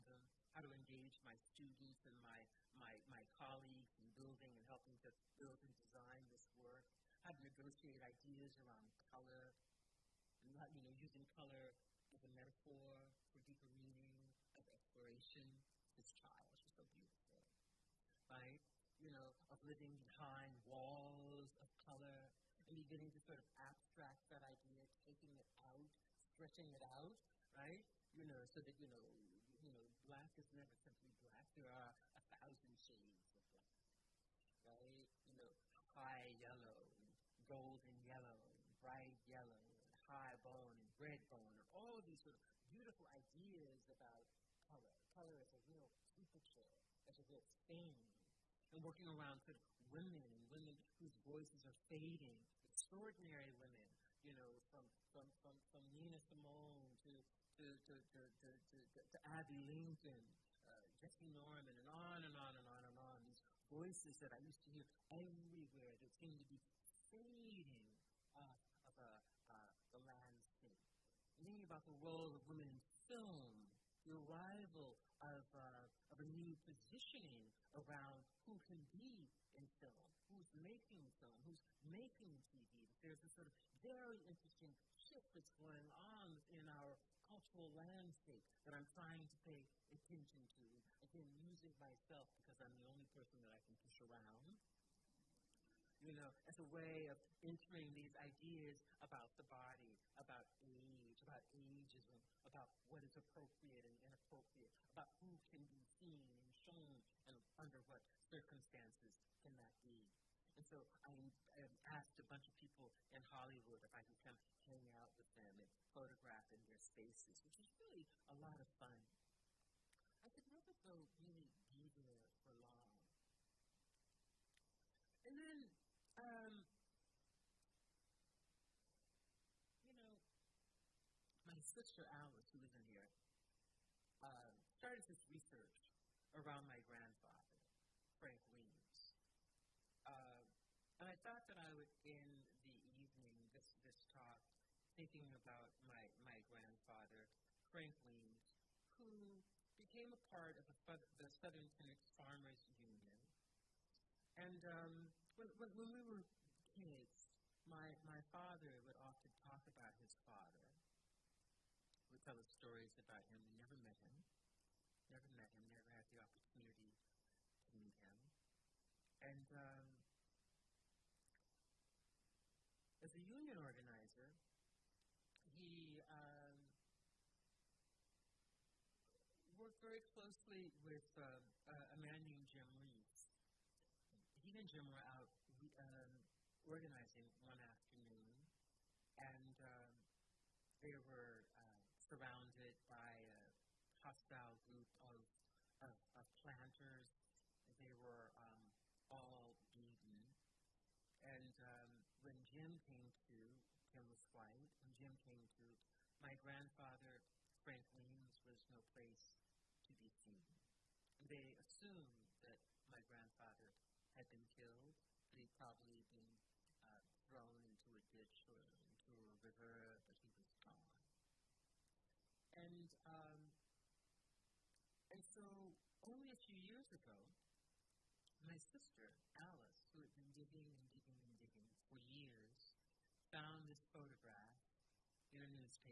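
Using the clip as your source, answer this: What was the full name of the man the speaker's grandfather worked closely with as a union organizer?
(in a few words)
Jim Reeves.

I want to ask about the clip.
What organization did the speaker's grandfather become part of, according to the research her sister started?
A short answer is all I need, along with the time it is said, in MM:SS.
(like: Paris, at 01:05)
Southern Phoenix Farmers Union, at 02:31.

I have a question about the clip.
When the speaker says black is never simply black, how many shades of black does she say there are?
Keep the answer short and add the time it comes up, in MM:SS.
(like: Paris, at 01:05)
1000, at 00:32.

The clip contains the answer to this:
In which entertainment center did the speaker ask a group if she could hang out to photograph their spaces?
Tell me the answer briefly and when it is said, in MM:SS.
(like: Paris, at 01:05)
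Hollywood, at 01:53.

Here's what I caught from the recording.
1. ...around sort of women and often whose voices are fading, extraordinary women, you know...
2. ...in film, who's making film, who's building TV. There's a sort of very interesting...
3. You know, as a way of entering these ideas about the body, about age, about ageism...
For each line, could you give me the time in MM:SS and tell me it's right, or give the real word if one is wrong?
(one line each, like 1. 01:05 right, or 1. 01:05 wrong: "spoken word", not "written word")
1. 00:49 wrong: "women", not "often"
2. 01:19 wrong: "making", not "building"
3. 01:36 right.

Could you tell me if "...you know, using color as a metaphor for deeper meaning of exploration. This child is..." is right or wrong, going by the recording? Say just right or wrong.
right.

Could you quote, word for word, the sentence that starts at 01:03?
These voices that I used to hear everywhere that seemed to be fading off of a, uh, uh, the landscape.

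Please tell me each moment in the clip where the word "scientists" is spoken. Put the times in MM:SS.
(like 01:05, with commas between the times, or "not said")
not said.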